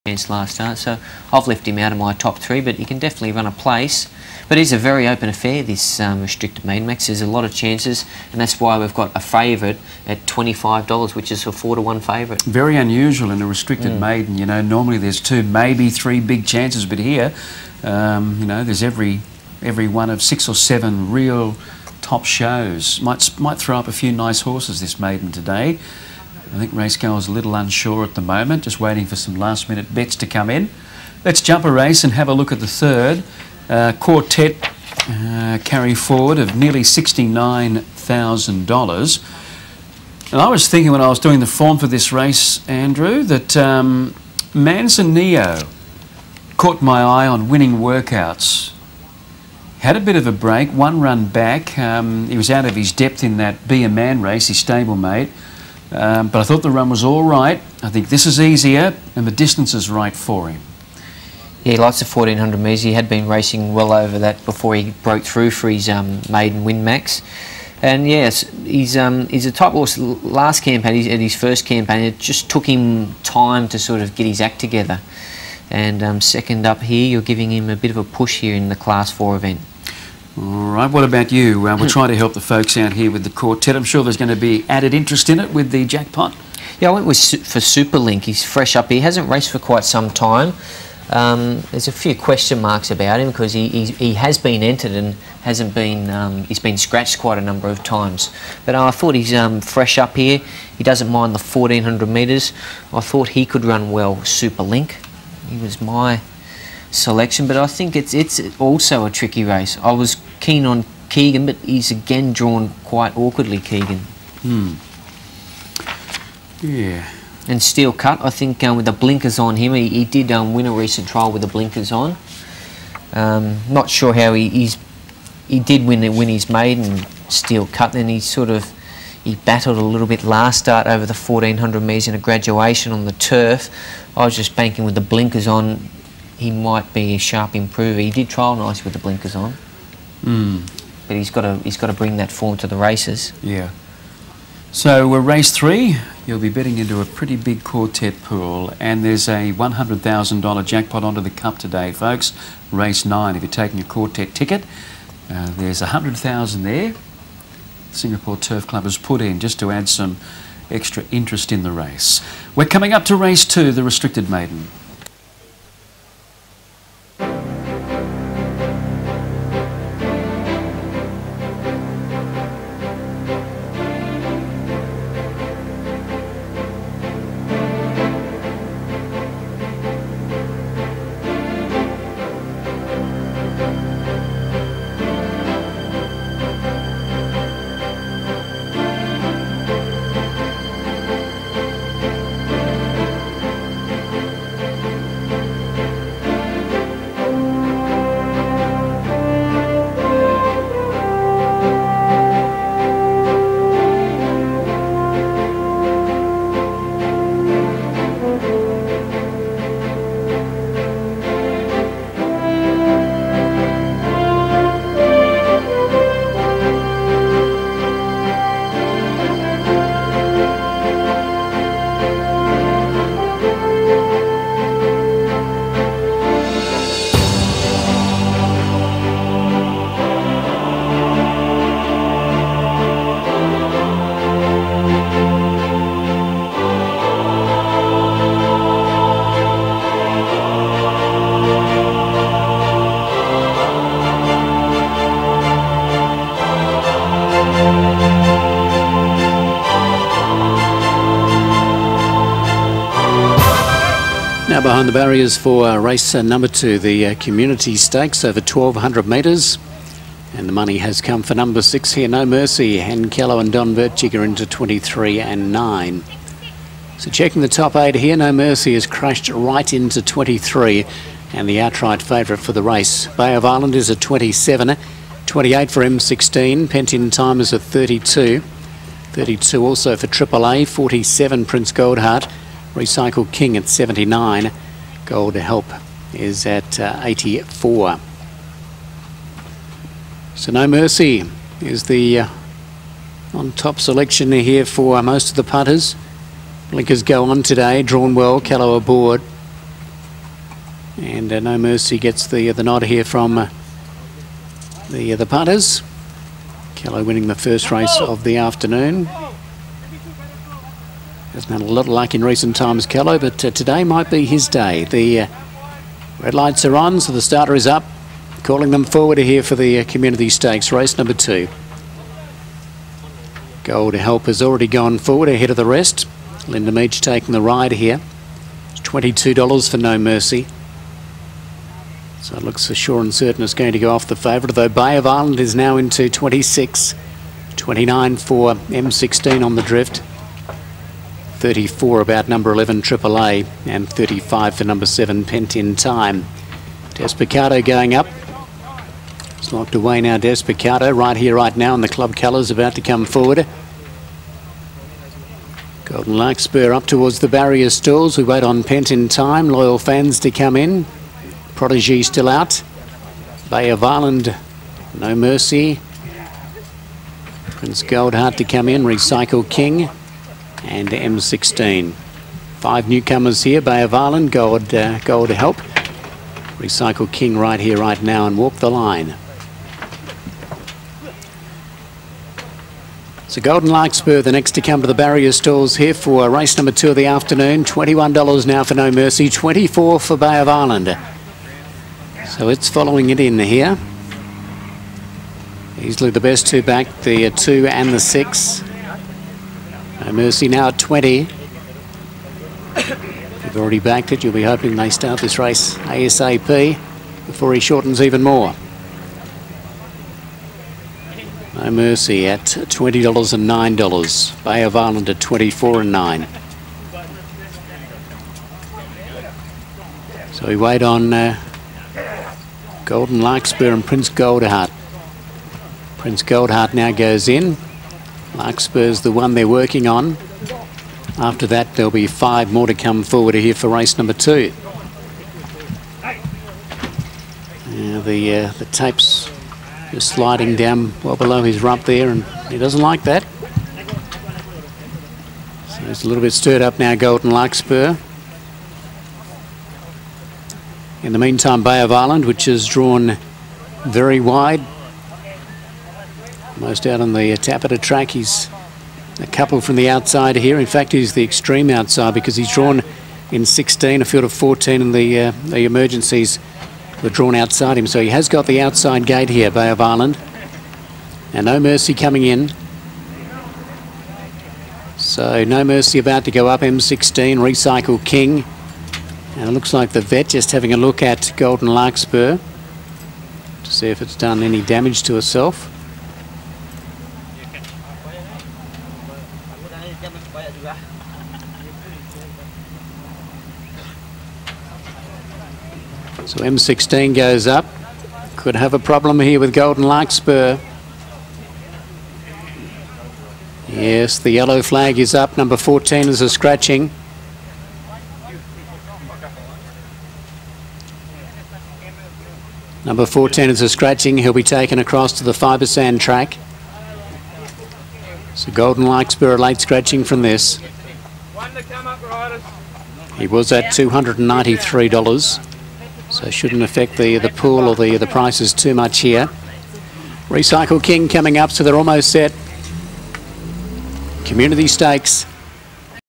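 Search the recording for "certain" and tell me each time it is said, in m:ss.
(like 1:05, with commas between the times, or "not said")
5:33.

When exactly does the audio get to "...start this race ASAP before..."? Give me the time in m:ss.
6:44.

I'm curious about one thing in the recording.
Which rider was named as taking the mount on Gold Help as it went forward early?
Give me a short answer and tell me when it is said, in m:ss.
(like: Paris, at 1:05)
Linda Meach, at 5:26.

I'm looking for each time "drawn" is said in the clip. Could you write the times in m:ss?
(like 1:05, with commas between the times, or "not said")
1:52, 4:57, 7:32, 7:42, 7:47.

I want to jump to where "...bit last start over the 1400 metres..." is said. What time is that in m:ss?
2:10.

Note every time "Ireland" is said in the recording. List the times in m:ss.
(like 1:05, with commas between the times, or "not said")
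4:33, 6:03, 6:30.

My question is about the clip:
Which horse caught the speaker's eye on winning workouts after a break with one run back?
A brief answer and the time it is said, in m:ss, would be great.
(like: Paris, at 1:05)
Manzanillo, at 0:44.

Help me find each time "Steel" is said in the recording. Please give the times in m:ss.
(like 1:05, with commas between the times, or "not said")
1:57, 2:07.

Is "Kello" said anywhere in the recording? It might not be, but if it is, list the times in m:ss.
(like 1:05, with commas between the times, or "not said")
4:23, 5:12.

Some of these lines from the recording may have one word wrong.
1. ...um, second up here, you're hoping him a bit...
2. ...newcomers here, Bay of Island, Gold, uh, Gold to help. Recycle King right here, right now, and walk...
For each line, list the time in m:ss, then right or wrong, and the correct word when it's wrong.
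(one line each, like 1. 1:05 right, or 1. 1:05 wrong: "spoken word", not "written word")
1. 1:16 wrong: "giving", not "hoping"
2. 6:12 right.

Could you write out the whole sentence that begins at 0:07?
There's a lot of chances, and that's why we've got a favourite at $25, which is a 4 to 1 favourite.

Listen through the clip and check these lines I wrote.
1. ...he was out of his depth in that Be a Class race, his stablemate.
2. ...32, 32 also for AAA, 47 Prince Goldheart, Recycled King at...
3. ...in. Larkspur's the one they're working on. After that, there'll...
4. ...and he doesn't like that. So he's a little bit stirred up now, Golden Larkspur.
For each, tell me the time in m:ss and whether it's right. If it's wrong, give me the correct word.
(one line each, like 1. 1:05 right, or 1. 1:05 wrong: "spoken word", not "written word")
1. 0:52 wrong: "Man", not "Class"
2. 4:37 right
3. 7:07 right
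4. 7:22 right.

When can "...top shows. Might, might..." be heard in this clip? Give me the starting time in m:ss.
0:22.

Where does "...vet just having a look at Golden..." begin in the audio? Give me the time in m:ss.
8:00.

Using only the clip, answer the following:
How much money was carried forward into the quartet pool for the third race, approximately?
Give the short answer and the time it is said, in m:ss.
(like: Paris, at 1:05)
$69,000, at 0:36.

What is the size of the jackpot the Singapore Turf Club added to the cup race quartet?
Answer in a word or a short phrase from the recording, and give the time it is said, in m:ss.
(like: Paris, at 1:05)
$100,000, at 2:29.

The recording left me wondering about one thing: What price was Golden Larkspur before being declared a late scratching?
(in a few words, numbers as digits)
$293.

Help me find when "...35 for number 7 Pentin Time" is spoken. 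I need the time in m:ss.
5:43.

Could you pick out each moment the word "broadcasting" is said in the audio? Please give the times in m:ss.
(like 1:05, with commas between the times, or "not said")
not said.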